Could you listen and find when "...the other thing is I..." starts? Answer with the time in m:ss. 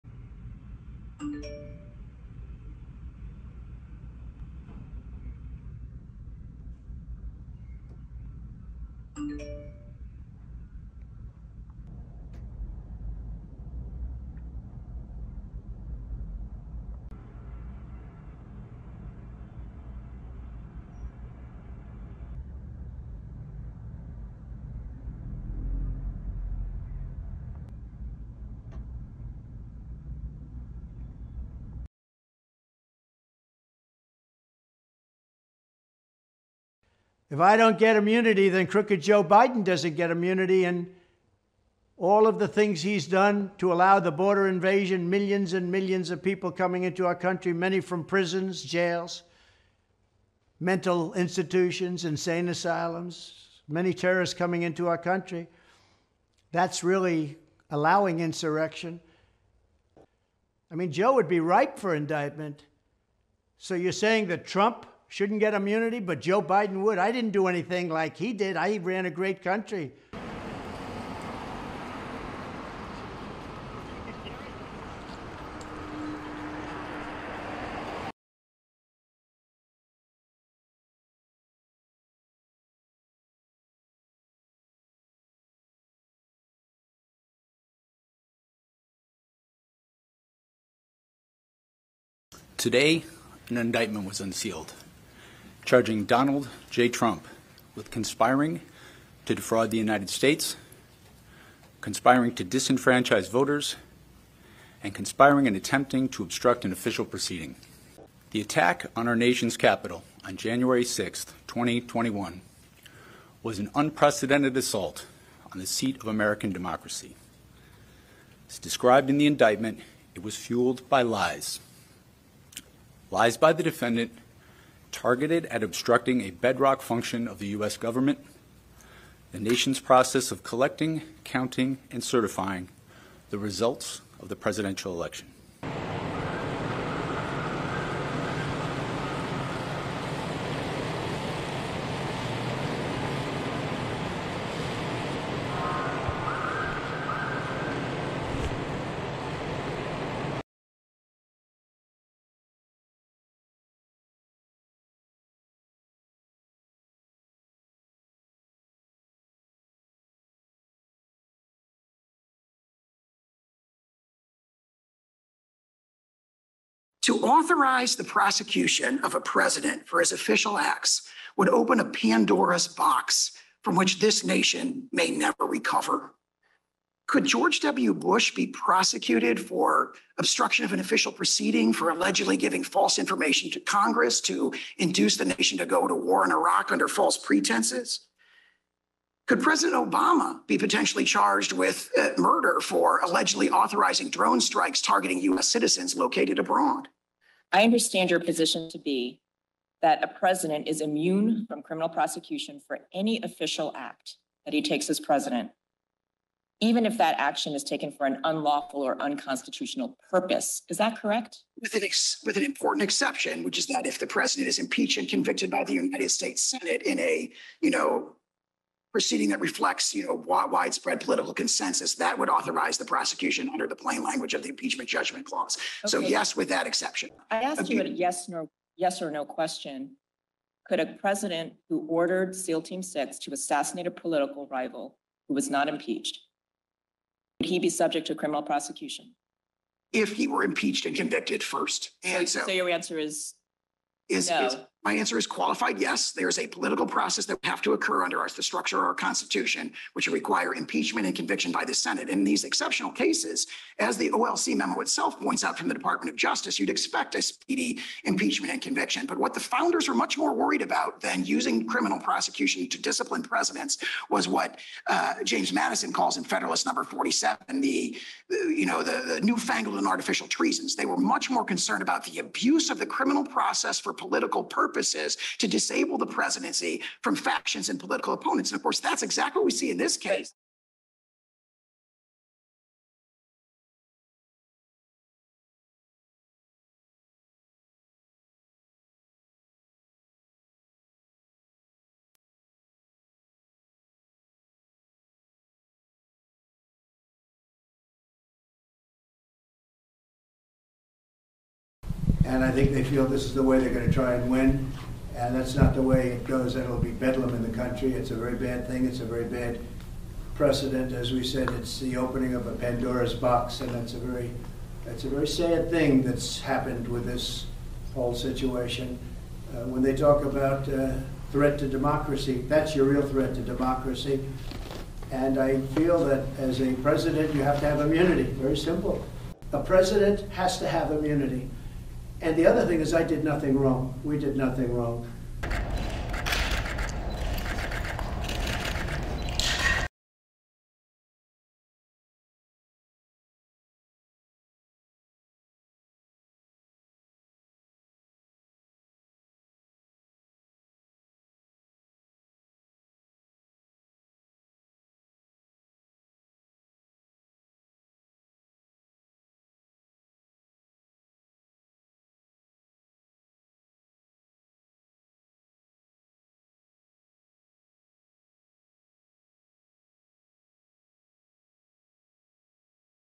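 5:32.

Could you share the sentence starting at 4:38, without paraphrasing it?
And of course, that's exactly what we see in this case.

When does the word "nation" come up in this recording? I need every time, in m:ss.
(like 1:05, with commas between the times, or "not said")
1:49, 2:09, 2:54, 3:05.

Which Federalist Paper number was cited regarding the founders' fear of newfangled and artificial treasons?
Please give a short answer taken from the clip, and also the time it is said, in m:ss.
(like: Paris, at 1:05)
47, at 4:26.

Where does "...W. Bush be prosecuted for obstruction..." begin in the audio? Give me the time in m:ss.
2:57.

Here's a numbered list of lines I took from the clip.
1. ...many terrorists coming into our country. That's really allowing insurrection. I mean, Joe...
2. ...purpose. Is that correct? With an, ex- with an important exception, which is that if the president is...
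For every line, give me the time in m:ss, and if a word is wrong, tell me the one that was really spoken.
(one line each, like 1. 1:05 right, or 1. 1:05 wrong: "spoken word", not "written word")
1. 0:53 right
2. 3:30 right.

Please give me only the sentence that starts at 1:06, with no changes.
I didn't do anything like he did.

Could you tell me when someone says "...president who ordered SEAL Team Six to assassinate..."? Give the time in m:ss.
3:50.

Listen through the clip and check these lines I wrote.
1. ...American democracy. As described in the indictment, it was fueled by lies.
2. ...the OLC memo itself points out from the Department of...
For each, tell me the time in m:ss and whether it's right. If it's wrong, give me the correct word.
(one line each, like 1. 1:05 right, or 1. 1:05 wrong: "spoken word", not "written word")
1. 1:56 right
2. 4:13 right.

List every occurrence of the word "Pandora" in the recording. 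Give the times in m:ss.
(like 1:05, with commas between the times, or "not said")
2:51, 5:12.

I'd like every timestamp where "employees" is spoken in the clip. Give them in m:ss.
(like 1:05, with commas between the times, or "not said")
not said.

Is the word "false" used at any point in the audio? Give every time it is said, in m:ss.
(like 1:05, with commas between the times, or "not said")
3:02, 3:06.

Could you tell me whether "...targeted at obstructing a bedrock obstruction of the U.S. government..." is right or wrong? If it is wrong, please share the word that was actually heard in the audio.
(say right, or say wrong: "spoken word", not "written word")
wrong: "function", not "obstruction".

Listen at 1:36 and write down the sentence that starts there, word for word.
Trump with conspiring to defraud the United States, conspiring to disenfranchise voters, and conspiring and attempting to obstruct an official proceeding.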